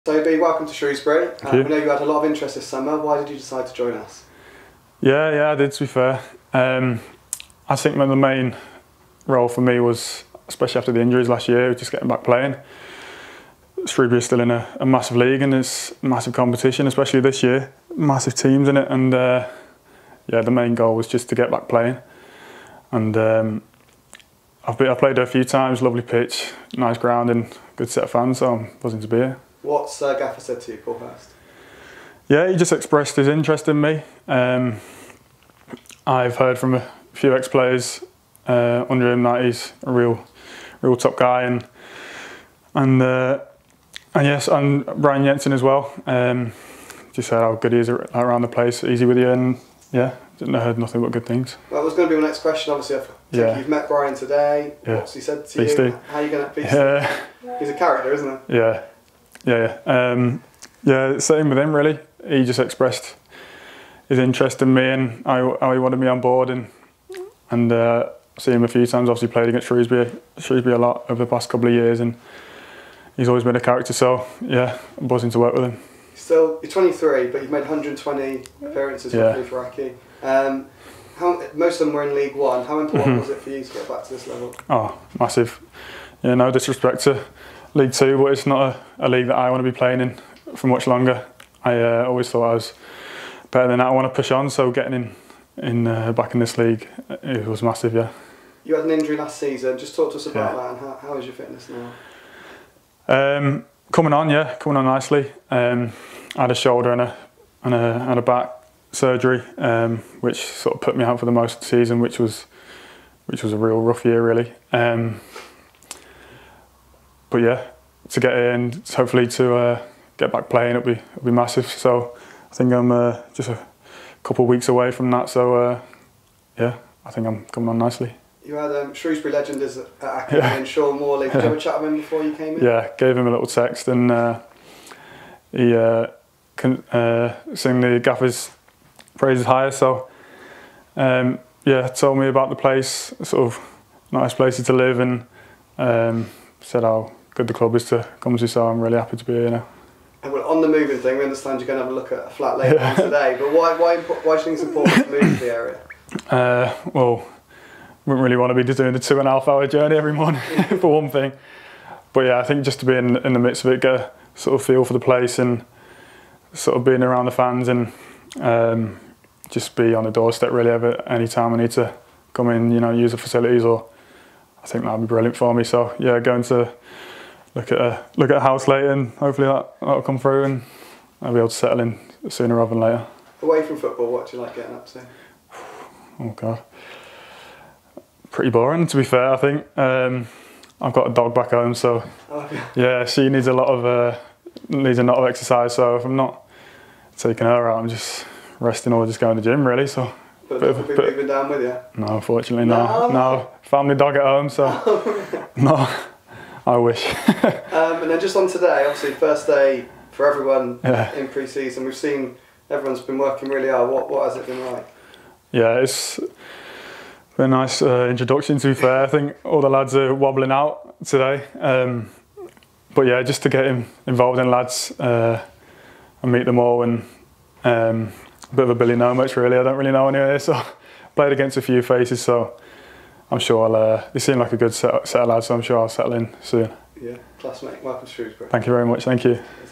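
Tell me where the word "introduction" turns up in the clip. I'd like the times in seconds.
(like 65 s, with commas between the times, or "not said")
218 s.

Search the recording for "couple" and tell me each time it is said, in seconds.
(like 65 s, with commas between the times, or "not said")
71 s, 124 s.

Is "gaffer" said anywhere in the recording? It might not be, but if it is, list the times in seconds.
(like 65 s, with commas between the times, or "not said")
30 s, 138 s.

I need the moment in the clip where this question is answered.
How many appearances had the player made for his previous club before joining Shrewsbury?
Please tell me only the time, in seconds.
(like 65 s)
77 s.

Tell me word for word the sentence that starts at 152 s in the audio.
today, but why, why, why do you think it's important to move to the area?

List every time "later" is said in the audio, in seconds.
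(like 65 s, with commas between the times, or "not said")
152 s, 178 s, 182 s.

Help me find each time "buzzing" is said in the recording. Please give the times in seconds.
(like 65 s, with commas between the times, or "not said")
28 s, 75 s.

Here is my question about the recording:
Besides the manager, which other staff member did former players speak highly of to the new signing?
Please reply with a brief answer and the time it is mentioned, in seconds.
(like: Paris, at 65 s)
Brian Jensen, at 44 s.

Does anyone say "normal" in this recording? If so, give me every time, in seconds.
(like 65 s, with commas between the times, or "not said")
not said.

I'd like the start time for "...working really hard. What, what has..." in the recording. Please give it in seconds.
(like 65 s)
213 s.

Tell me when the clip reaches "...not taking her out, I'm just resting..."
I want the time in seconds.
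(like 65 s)
196 s.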